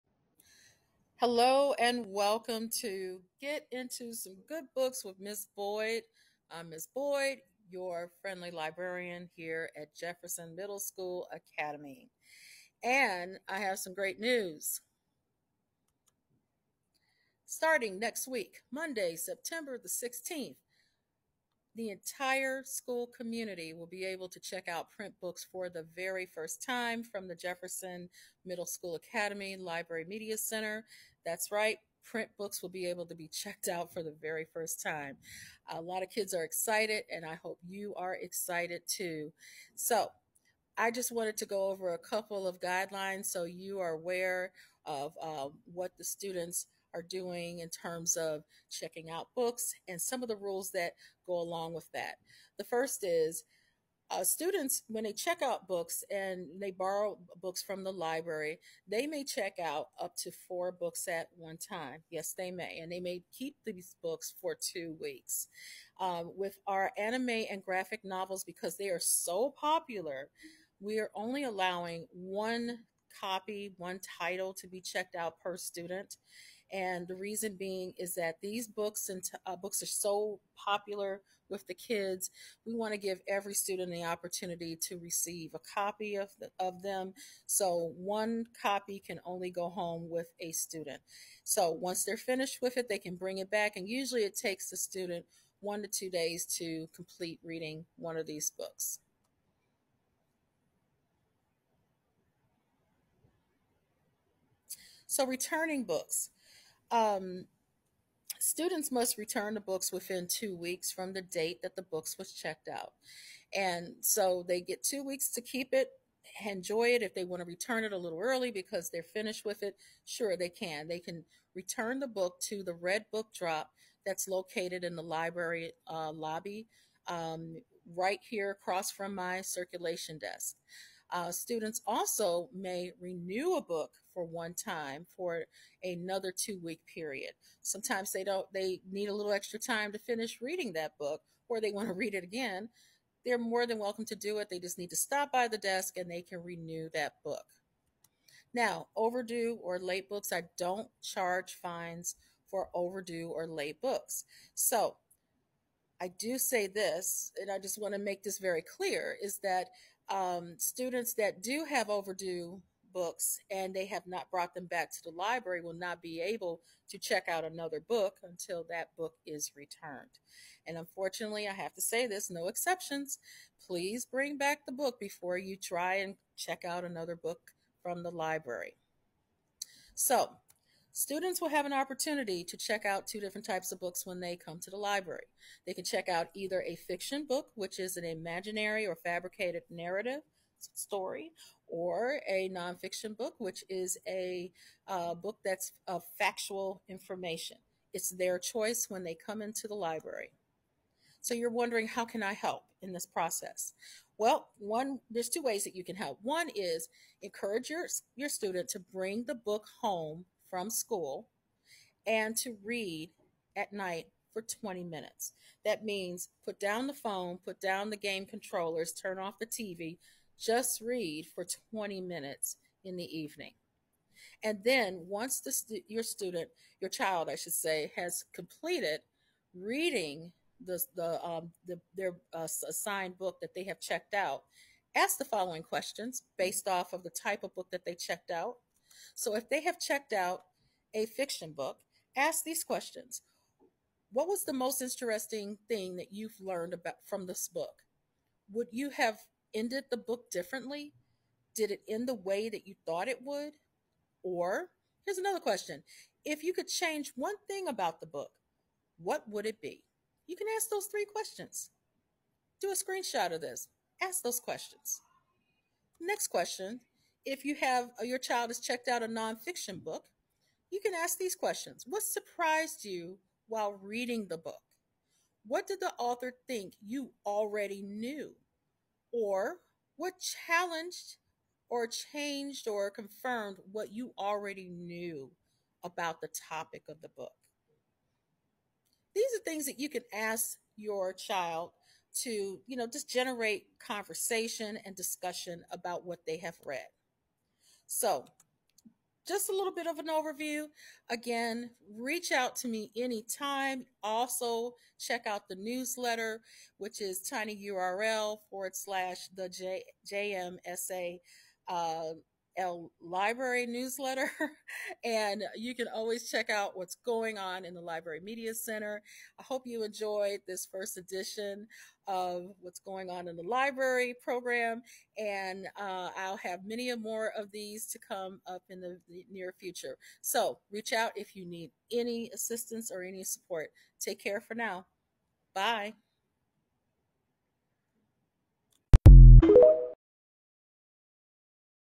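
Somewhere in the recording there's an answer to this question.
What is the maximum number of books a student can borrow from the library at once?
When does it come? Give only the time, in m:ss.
1:00.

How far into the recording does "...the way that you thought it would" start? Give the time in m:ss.
4:12.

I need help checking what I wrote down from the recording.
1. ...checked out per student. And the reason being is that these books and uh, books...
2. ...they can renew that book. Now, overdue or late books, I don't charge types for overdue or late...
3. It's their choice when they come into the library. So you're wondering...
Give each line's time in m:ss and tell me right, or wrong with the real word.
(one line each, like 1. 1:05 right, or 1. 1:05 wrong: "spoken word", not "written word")
1. 1:14 right
2. 2:26 wrong: "fines", not "types"
3. 3:17 right.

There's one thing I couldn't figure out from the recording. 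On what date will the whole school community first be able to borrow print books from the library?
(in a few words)
Monday, September 16th.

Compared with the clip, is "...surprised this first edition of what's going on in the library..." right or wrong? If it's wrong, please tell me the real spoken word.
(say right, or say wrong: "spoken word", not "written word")
wrong: "enjoyed", not "surprised".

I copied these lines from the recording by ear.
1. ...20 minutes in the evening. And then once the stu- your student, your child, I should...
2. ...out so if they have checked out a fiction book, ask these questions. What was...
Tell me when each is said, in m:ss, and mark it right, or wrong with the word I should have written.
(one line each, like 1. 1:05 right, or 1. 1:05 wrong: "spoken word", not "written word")
1. 3:41 right
2. 3:58 right.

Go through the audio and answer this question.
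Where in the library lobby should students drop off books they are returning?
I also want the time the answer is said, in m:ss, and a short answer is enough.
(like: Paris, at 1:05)
red book drop, at 2:02.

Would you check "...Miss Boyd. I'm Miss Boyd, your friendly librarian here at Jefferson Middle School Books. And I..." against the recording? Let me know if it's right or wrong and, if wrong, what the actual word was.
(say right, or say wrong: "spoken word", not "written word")
wrong: "Academy", not "Books".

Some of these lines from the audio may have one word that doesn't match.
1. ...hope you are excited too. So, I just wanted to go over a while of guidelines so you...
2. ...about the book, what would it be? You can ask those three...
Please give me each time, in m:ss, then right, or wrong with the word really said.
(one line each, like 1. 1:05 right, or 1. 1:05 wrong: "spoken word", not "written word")
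1. 0:37 wrong: "couple", not "while"
2. 4:17 right.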